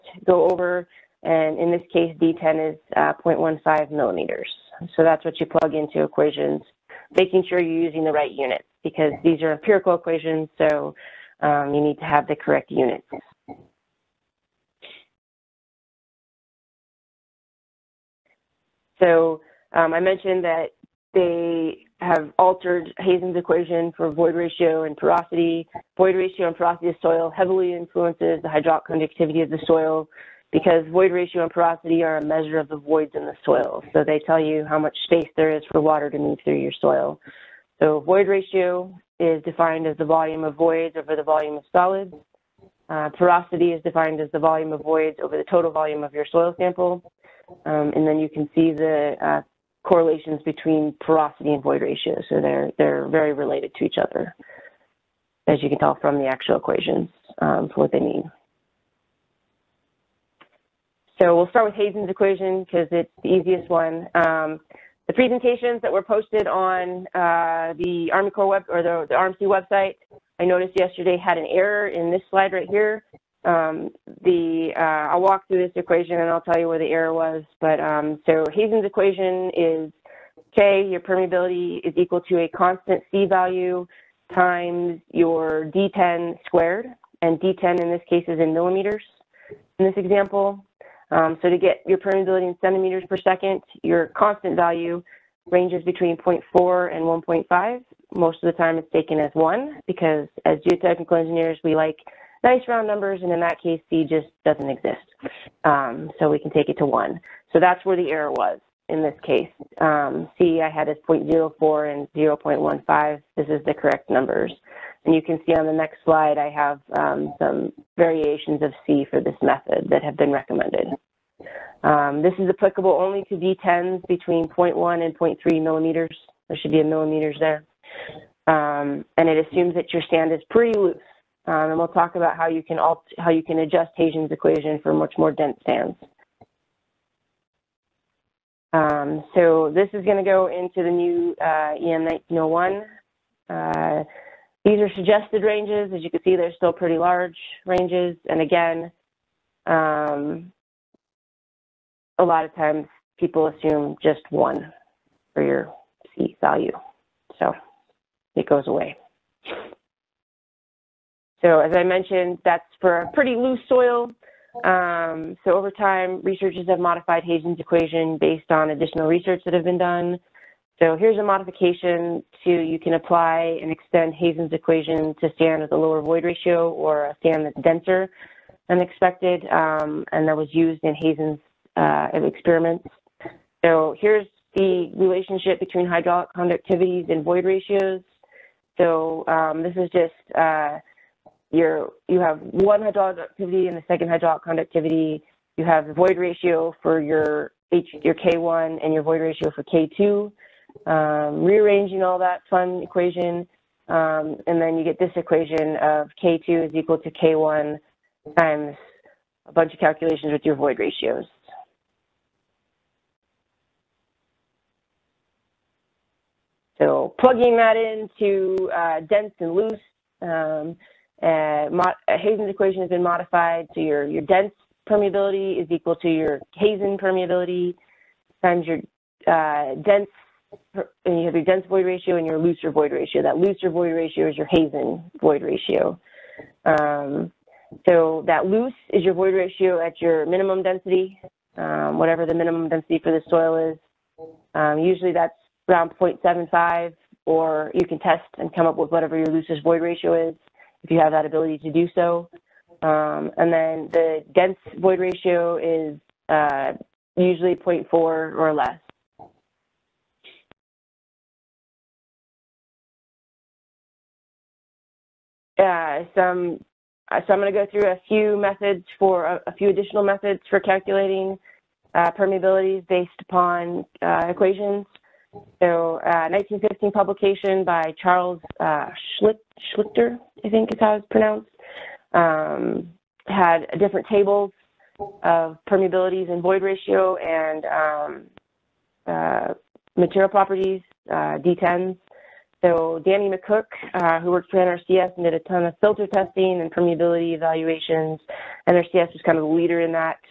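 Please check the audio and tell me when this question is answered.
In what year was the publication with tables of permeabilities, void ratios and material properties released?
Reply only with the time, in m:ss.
4:36.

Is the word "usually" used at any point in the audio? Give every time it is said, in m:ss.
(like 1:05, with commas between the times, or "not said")
4:04, 4:17.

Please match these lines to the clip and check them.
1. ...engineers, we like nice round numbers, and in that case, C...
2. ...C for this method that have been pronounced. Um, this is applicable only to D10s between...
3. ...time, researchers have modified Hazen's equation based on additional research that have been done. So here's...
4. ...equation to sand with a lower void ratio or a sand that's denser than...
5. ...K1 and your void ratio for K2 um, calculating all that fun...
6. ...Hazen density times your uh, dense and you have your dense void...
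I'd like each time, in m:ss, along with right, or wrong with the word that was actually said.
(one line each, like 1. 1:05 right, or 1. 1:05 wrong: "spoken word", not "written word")
1. 1:41 right
2. 1:58 wrong: "recommended", not "pronounced"
3. 2:45 right
4. 2:54 right
5. 3:18 wrong: "rearranging", not "calculating"
6. 3:46 wrong: "permeability", not "density".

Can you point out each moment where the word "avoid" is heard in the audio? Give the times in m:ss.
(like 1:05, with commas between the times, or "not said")
not said.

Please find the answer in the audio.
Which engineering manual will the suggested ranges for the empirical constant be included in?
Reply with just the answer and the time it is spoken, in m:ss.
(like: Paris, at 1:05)
EM 1901, at 2:21.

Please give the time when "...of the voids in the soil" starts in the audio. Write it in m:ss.
0:32.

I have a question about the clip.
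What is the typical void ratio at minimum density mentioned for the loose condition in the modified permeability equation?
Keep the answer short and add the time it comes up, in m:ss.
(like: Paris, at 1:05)
0.75, at 4:05.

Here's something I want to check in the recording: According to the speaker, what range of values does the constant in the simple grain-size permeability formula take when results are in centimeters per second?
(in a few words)
0.4 to 1.5.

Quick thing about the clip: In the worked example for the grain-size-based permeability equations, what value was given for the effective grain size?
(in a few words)
0.15 millimeters.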